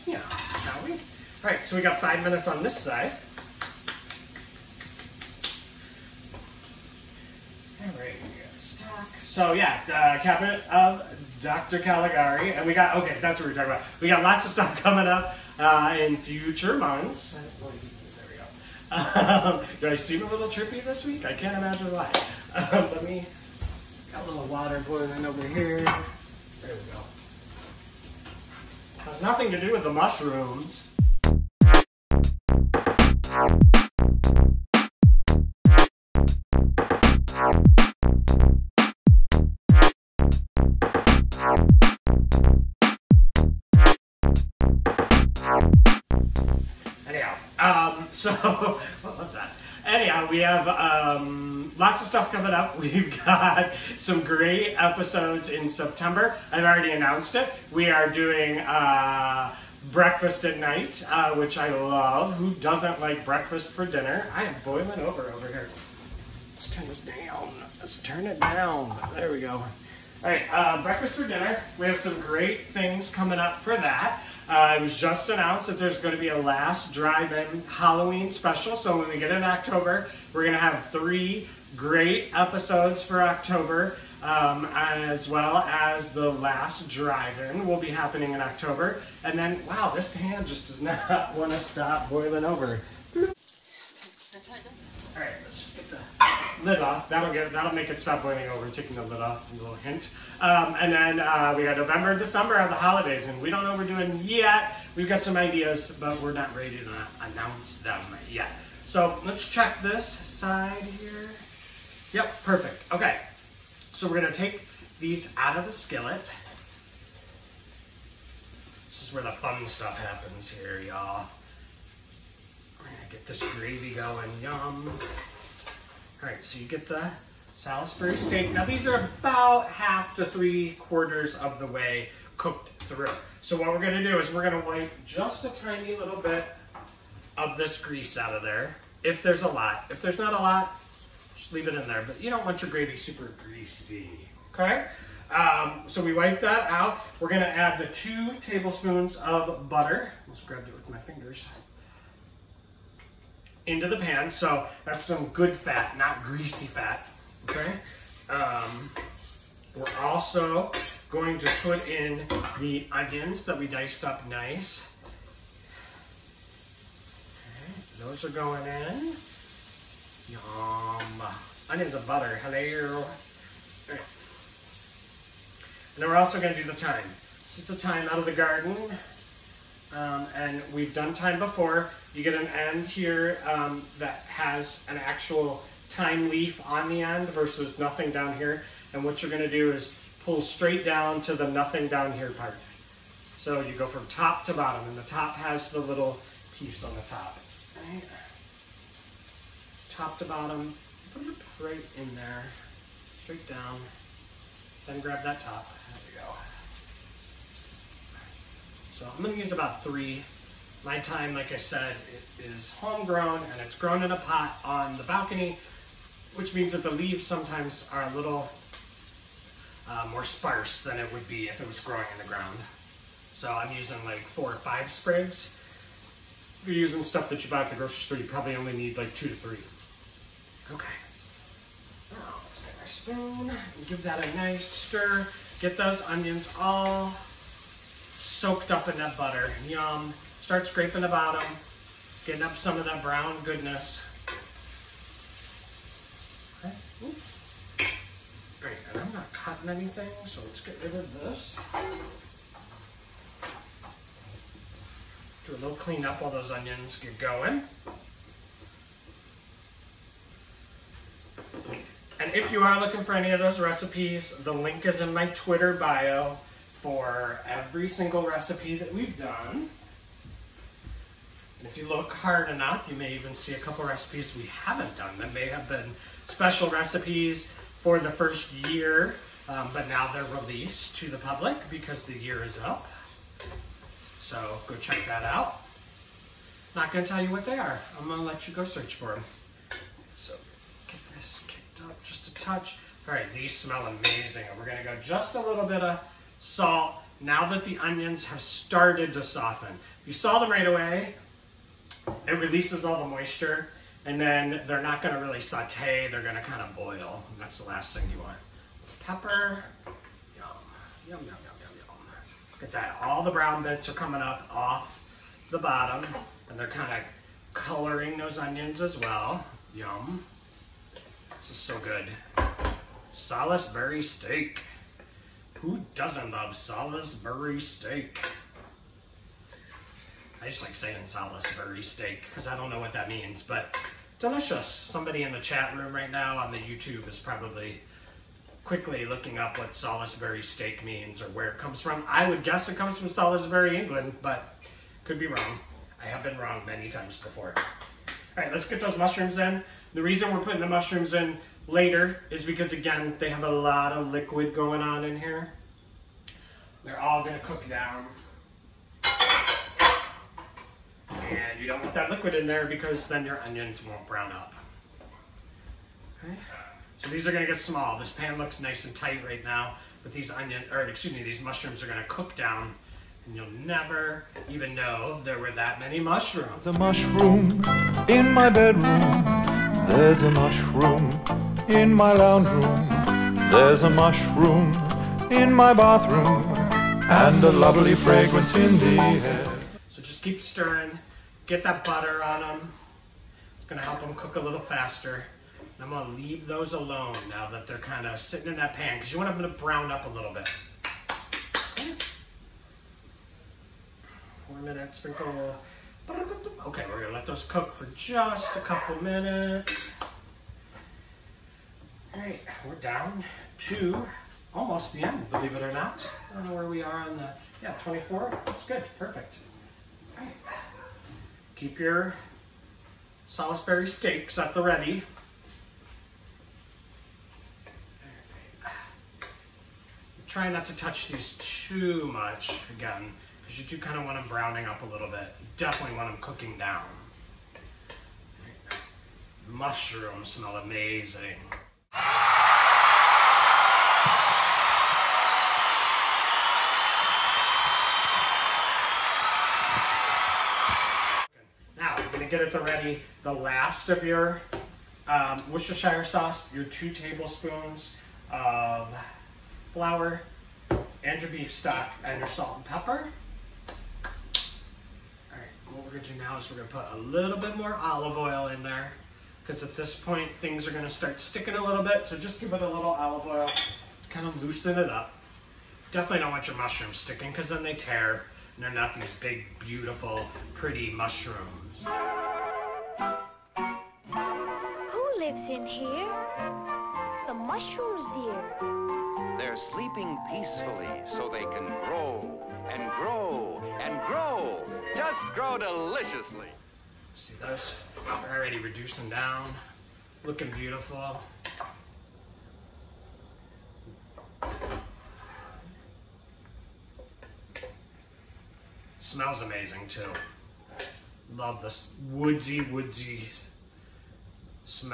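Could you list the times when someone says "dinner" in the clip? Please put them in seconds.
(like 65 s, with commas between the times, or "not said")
63 s, 71 s.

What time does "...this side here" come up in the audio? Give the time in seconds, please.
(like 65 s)
109 s.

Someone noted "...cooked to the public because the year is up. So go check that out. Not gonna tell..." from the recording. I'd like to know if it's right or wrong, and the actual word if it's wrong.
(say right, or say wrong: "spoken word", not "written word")
wrong: "released", not "cooked".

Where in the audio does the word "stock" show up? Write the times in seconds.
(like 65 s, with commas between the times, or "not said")
8 s, 461 s.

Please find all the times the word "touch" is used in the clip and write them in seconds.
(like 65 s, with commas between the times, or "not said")
292 s, 430 s.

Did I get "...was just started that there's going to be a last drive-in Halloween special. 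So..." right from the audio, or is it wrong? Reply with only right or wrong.
wrong.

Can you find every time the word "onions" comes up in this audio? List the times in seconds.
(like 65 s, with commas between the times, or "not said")
162 s, 171 s, 236 s, 256 s, 297 s, 318 s, 363 s, 370 s.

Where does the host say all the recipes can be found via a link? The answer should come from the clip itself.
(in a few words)
Twitter bio.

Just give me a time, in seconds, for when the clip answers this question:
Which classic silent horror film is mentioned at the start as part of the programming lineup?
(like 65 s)
10 s.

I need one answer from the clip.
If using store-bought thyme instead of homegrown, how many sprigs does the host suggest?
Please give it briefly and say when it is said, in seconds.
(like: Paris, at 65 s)
2 to 3, at 229 s.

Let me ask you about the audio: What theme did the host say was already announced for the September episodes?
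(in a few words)
Breakfast at night.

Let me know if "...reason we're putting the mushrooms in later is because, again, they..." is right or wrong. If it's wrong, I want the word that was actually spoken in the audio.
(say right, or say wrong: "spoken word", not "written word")
right.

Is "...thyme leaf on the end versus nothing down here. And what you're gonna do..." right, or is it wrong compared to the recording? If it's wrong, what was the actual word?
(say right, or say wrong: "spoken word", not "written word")
right.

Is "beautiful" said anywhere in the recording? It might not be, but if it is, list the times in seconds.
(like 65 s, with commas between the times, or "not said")
479 s, 500 s.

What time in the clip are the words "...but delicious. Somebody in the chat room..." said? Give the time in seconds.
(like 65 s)
333 s.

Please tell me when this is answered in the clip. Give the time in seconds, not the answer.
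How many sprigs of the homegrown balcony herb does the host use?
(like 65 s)
224 s.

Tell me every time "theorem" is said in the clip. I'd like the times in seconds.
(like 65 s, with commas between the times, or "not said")
not said.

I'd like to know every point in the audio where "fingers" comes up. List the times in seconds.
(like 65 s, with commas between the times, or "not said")
150 s.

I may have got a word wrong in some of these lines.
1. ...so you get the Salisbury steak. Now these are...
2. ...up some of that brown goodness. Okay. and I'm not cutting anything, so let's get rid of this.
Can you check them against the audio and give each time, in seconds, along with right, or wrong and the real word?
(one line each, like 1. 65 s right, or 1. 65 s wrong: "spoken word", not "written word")
1. 126 s right
2. 242 s right.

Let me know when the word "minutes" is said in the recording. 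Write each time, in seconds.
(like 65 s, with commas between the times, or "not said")
2 s, 404 s, 409 s.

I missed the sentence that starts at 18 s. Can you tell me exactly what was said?
Um, do I seem a little trippy this week?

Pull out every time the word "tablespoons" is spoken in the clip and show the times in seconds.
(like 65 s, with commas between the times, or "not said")
148 s, 456 s.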